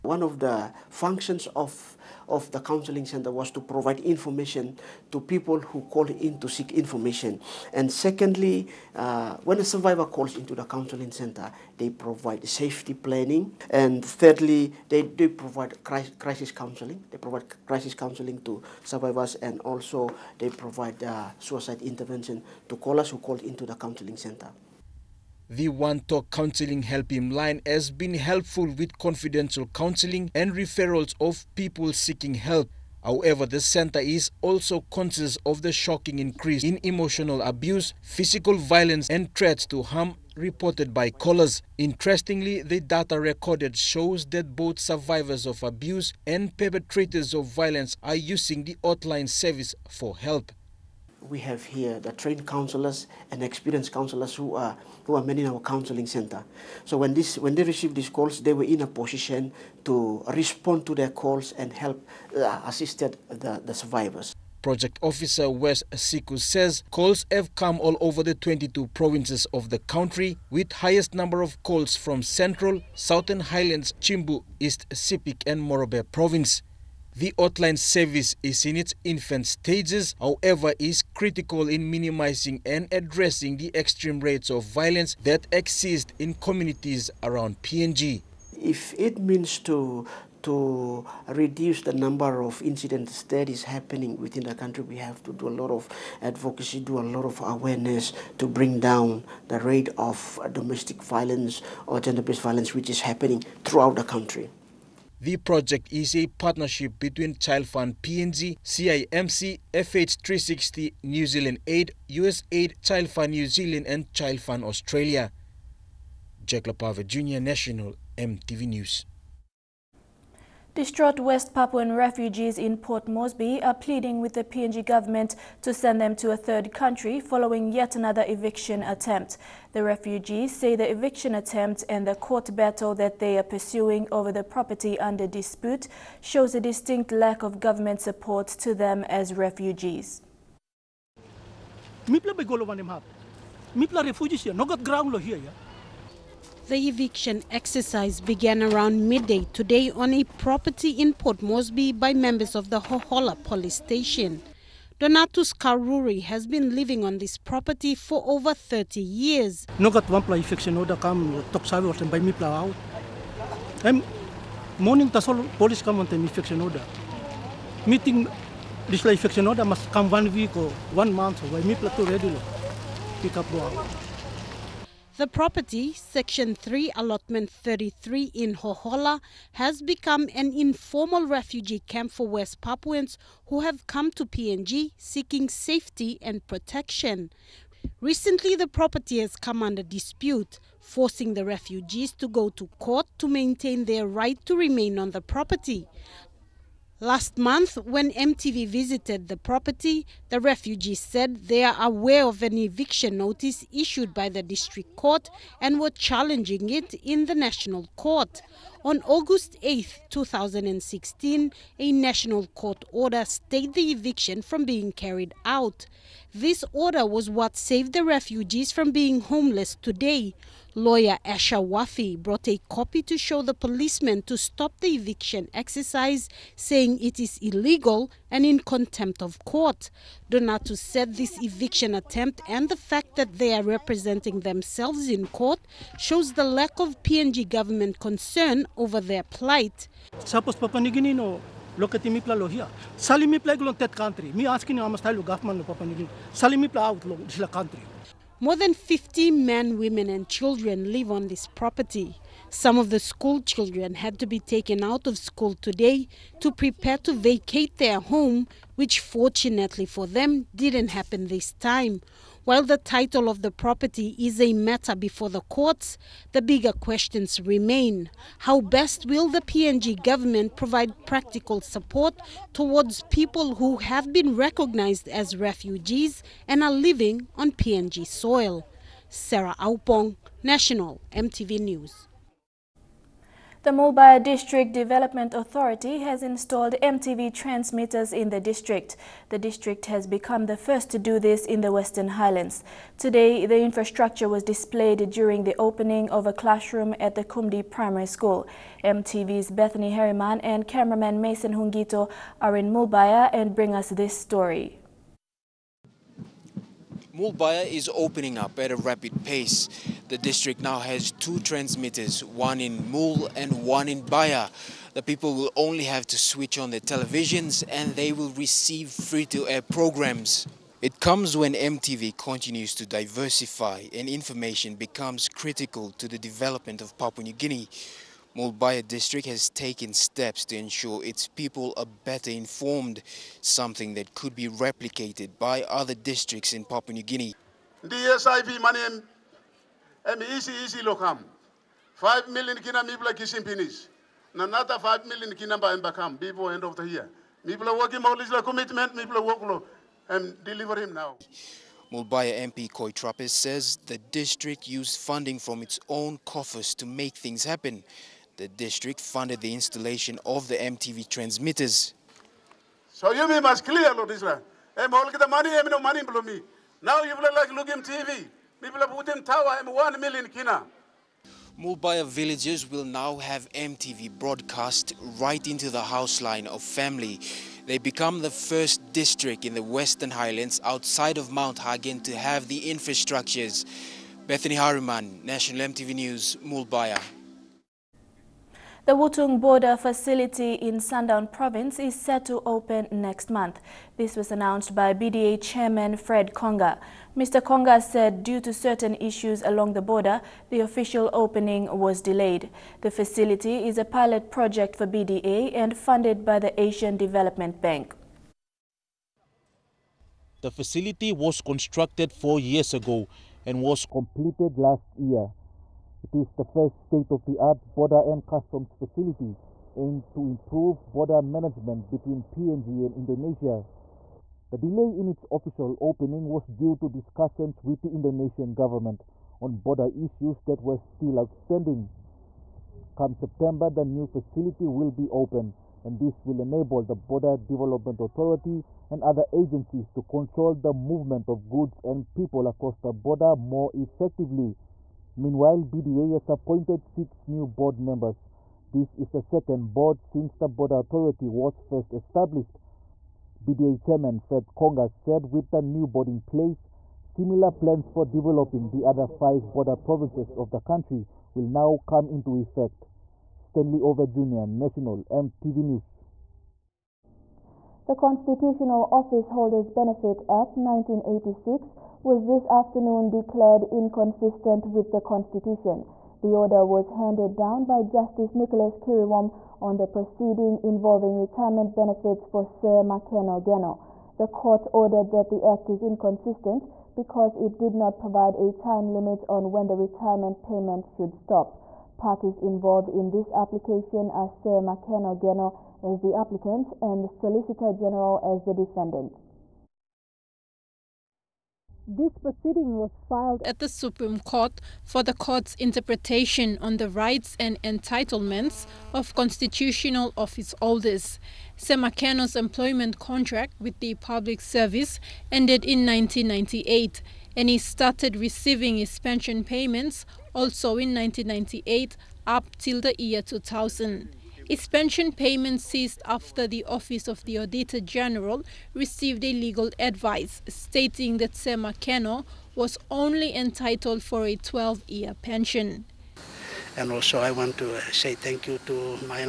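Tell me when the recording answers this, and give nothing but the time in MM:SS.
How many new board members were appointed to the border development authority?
07:26.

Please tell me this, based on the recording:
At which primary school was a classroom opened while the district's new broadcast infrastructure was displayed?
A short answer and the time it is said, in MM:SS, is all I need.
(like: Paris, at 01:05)
Kumdi Primary School, at 04:57.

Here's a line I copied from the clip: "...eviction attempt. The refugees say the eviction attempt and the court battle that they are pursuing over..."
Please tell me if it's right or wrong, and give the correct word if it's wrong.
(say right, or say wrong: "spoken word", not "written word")
right.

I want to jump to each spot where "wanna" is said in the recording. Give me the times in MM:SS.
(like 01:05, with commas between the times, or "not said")
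not said.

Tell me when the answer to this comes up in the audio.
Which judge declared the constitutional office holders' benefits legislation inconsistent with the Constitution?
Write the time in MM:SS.
07:58.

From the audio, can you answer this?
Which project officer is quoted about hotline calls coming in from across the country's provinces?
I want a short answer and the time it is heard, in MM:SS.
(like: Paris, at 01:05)
Wes Siku, at 01:05.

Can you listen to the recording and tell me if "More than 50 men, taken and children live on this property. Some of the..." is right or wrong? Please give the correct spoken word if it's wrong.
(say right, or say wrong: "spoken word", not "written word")
wrong: "women", not "taken".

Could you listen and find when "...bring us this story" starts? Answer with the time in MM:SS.
05:03.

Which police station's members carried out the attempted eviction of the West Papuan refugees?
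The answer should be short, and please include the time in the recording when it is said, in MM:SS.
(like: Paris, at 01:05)
Hohola police station, at 02:32.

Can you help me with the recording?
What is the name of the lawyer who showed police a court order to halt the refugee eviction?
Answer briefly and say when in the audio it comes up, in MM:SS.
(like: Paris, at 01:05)
Asha Wafi, at 03:41.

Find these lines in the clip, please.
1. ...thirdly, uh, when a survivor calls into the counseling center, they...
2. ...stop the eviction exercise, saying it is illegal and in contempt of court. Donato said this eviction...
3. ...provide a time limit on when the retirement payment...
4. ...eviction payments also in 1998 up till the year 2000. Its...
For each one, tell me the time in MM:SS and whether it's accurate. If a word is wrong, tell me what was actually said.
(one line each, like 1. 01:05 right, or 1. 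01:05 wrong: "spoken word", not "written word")
1. 00:07 wrong: "secondly", not "thirdly"
2. 03:44 right
3. 08:08 right
4. 08:38 wrong: "pension", not "eviction".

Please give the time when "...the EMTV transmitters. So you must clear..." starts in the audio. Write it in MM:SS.
06:00.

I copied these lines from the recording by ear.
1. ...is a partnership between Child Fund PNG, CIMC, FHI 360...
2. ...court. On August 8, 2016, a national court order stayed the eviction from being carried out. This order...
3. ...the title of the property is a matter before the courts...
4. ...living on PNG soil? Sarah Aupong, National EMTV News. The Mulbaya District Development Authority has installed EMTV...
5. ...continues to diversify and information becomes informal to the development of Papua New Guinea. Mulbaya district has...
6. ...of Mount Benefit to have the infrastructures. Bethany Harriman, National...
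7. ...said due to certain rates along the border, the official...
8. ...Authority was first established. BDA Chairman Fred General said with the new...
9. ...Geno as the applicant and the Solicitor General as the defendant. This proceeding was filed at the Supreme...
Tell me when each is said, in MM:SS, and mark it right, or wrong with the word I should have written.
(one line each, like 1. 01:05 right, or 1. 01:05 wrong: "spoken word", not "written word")
1. 01:45 right
2. 03:27 right
3. 04:22 right
4. 04:36 right
5. 05:22 wrong: "critical", not "informal"
6. 06:21 wrong: "Hagen", not "Benefit"
7. 06:37 wrong: "issues", not "rates"
8. 07:30 wrong: "Conga", not "General"
9. 08:15 right.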